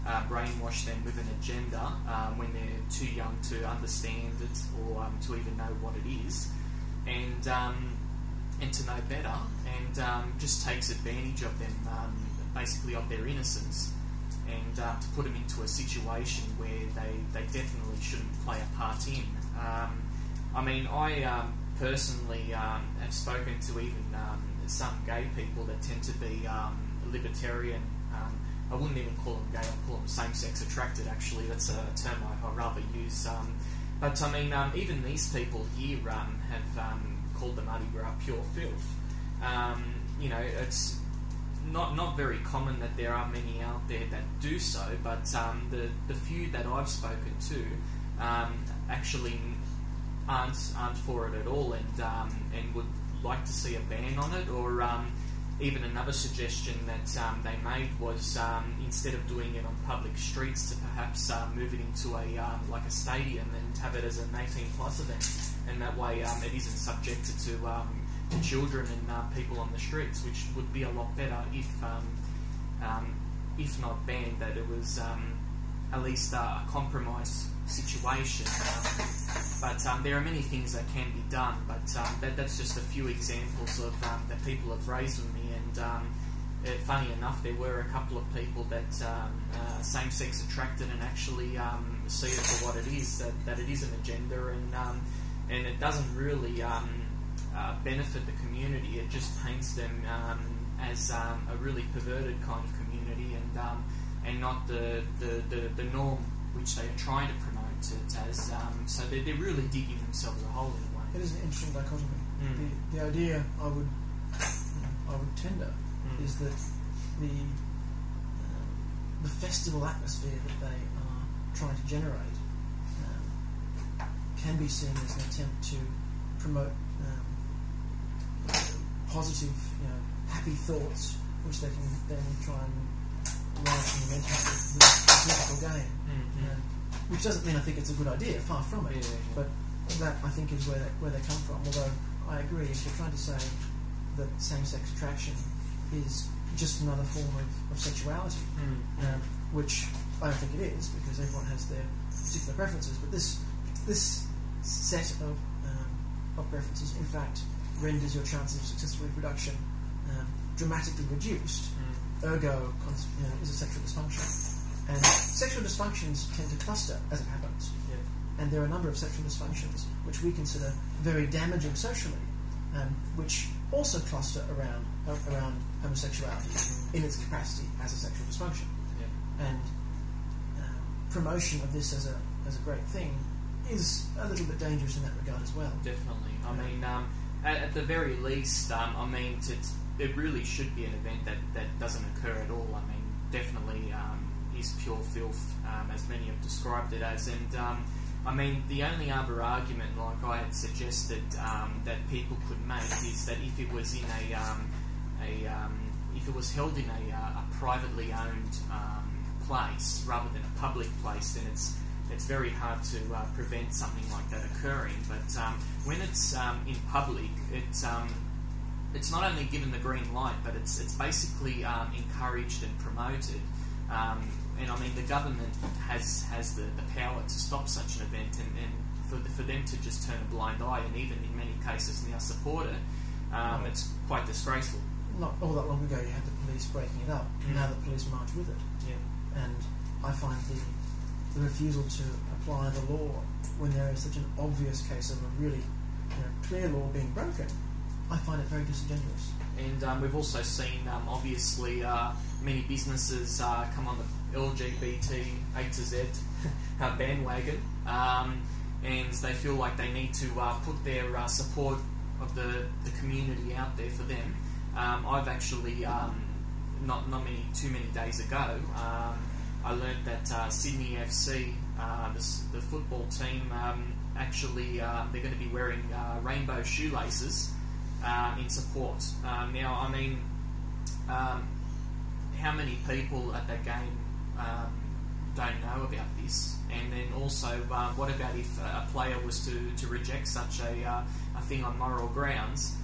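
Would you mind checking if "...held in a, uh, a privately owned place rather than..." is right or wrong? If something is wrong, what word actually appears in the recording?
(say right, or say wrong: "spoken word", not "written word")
right.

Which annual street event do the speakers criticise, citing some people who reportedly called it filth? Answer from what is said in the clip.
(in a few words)
Mardi Gras.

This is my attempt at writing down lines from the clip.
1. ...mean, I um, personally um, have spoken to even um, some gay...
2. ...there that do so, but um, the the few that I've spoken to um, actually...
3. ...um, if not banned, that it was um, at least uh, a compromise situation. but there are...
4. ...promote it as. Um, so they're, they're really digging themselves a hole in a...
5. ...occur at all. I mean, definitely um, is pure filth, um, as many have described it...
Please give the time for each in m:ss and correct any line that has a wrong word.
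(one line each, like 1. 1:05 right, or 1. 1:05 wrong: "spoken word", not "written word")
1. 0:20 right
2. 0:43 right
3. 1:12 right
4. 1:47 right
5. 3:12 right.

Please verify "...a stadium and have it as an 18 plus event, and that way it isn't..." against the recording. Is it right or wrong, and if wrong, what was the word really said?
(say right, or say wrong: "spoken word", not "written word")
right.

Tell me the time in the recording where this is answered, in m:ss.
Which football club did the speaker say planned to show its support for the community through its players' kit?
4:30.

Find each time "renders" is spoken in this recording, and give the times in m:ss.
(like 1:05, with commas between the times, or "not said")
2:37.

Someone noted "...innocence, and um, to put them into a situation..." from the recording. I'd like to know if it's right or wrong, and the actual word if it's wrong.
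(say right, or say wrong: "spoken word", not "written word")
right.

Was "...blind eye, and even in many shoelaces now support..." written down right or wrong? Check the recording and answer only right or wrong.
wrong.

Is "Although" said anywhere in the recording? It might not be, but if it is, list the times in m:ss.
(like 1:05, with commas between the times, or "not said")
2:21.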